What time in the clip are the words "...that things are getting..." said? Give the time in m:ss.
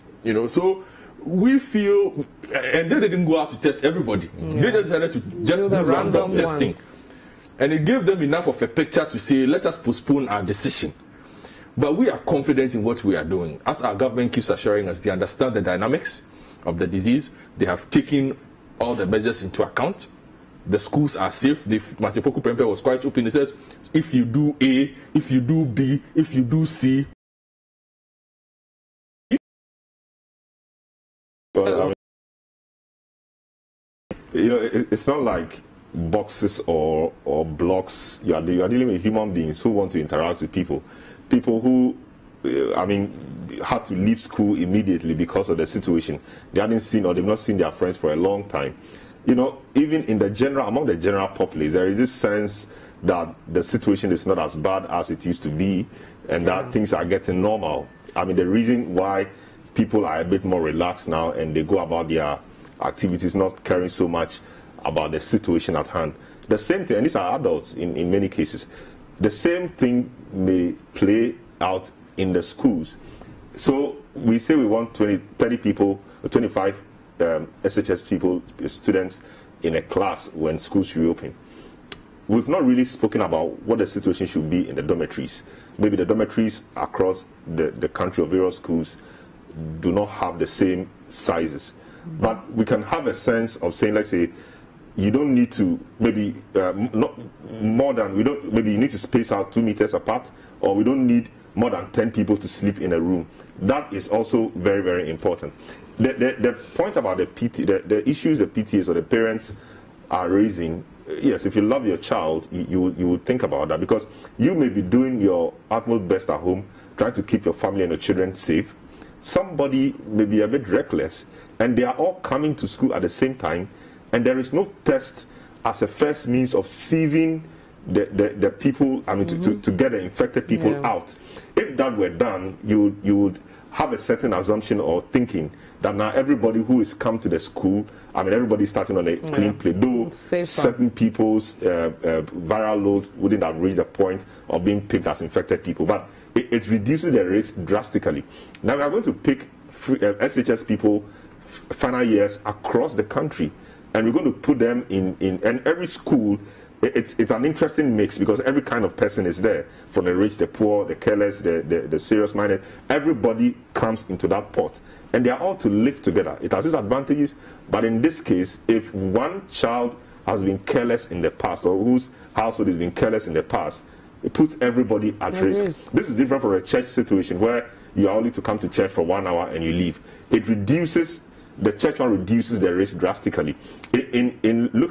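0:56.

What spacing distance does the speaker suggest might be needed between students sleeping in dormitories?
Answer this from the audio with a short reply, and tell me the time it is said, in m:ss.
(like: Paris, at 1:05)
2 meters, at 1:39.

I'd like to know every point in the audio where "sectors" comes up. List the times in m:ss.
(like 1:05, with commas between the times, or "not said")
not said.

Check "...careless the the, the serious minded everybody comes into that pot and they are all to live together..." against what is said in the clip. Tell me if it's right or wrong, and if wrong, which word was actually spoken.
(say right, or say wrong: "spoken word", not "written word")
right.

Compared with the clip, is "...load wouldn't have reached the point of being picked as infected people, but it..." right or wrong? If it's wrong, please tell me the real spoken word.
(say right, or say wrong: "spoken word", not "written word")
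right.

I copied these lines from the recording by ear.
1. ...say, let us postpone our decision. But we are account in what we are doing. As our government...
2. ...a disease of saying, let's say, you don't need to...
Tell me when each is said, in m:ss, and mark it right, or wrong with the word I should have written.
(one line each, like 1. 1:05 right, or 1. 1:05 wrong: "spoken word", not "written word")
1. 0:09 wrong: "confident", not "account"
2. 1:33 wrong: "sense", not "disease".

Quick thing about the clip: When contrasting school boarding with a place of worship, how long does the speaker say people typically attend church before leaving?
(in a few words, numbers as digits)
1 hour.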